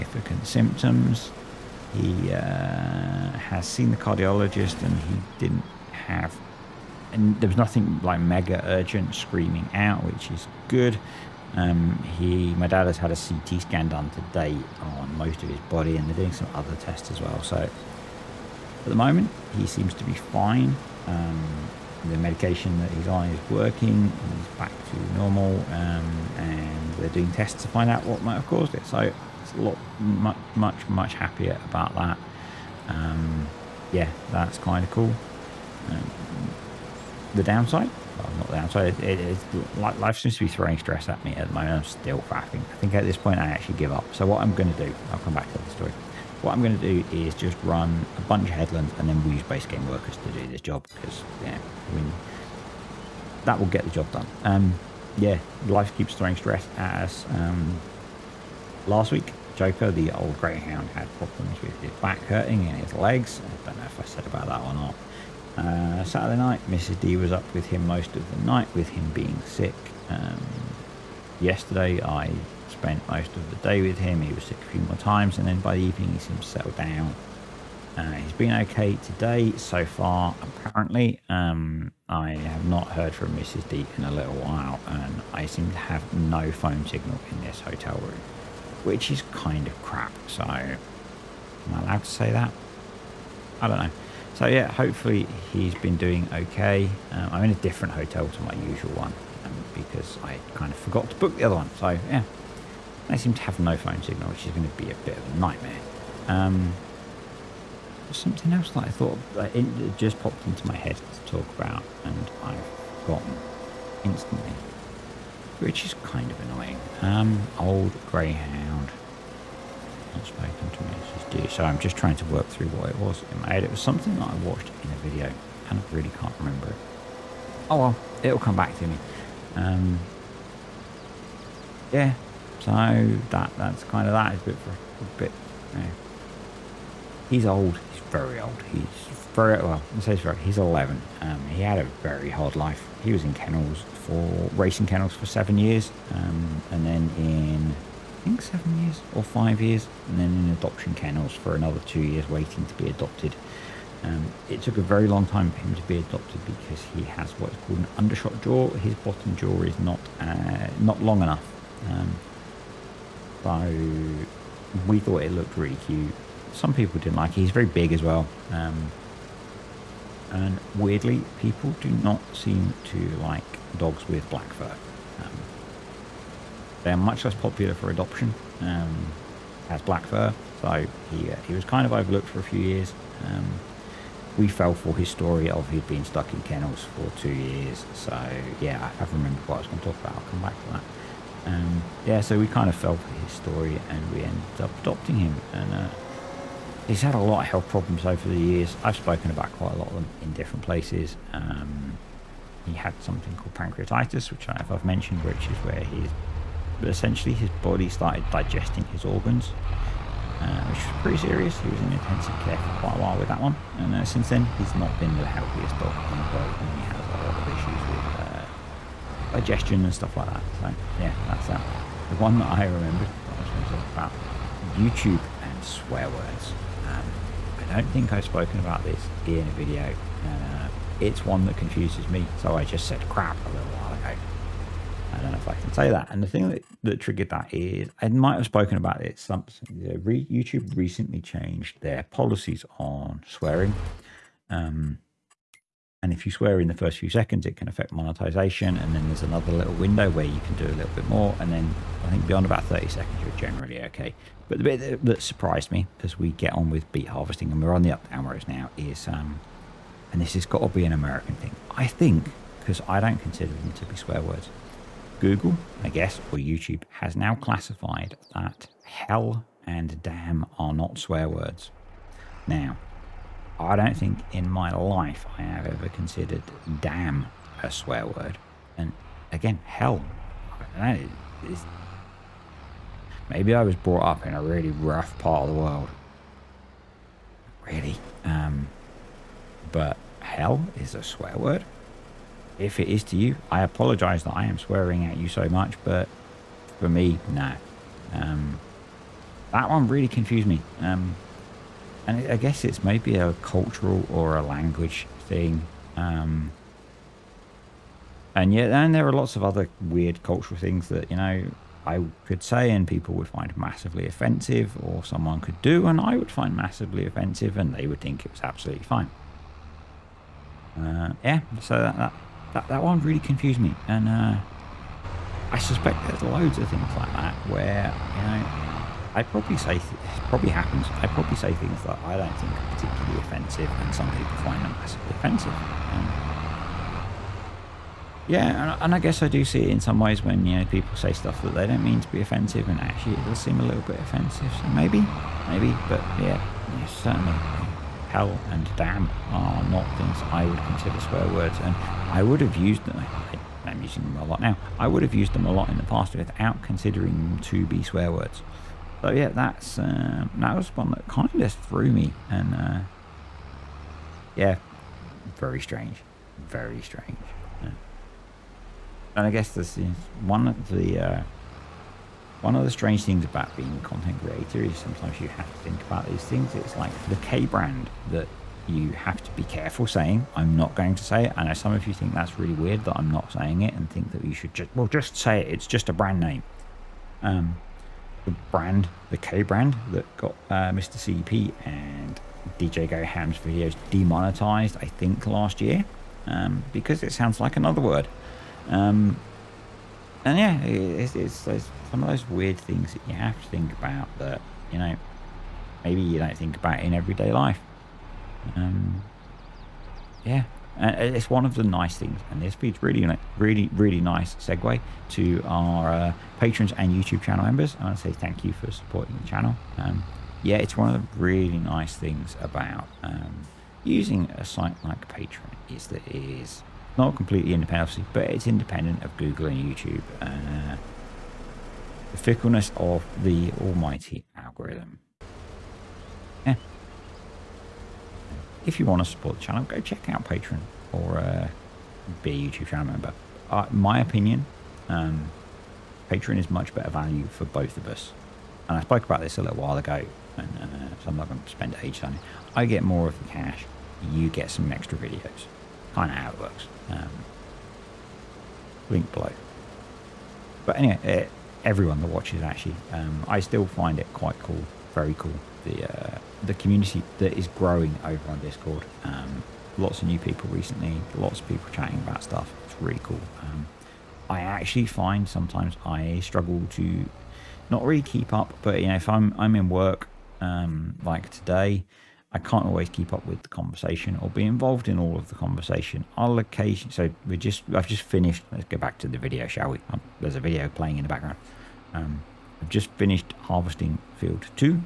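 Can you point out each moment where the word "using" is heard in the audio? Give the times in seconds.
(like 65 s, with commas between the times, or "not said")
353 s, 423 s.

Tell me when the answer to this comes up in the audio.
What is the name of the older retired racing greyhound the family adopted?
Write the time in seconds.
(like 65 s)
59 s.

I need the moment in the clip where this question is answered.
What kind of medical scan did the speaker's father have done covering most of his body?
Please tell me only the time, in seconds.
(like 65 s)
13 s.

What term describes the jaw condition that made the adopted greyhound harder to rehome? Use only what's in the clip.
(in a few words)
undershot jaw.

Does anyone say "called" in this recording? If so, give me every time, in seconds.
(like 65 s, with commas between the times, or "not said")
157 s, 203 s.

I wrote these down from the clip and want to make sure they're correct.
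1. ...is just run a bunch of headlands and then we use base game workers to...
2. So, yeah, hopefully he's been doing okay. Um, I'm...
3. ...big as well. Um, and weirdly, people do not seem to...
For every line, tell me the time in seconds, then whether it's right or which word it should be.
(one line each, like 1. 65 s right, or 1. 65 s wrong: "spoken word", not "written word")
1. 47 s right
2. 94 s right
3. 167 s right.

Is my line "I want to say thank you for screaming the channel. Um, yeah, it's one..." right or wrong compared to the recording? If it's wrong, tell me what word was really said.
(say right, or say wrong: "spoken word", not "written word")
wrong: "supporting", not "screaming".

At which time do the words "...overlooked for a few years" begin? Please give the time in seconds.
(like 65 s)
181 s.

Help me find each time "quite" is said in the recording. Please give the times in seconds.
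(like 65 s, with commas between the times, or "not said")
199 s, 212 s, 464 s.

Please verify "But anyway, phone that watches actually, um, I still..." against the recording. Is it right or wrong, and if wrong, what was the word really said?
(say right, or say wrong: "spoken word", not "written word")
wrong: "everyone", not "phone".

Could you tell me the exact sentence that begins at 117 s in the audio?
Um, old greyhound not spoken to me.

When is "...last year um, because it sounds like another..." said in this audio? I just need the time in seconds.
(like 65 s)
395 s.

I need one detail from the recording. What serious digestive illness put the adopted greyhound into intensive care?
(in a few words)
pancreatitis.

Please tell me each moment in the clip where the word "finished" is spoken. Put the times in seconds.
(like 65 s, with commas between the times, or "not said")
488 s, 492 s.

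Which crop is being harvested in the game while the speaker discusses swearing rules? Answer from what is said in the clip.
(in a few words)
beet.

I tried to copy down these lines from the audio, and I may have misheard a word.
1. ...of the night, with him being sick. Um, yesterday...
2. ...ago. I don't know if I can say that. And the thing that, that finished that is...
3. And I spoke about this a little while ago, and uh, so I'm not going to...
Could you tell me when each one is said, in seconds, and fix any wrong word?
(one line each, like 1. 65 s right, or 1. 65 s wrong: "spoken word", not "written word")
1. 68 s right
2. 233 s wrong: "triggered", not "finished"
3. 448 s right.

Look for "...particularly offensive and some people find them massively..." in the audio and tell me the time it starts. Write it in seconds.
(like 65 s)
332 s.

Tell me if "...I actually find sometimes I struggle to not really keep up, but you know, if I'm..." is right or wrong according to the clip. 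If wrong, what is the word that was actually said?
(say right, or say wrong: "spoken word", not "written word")
right.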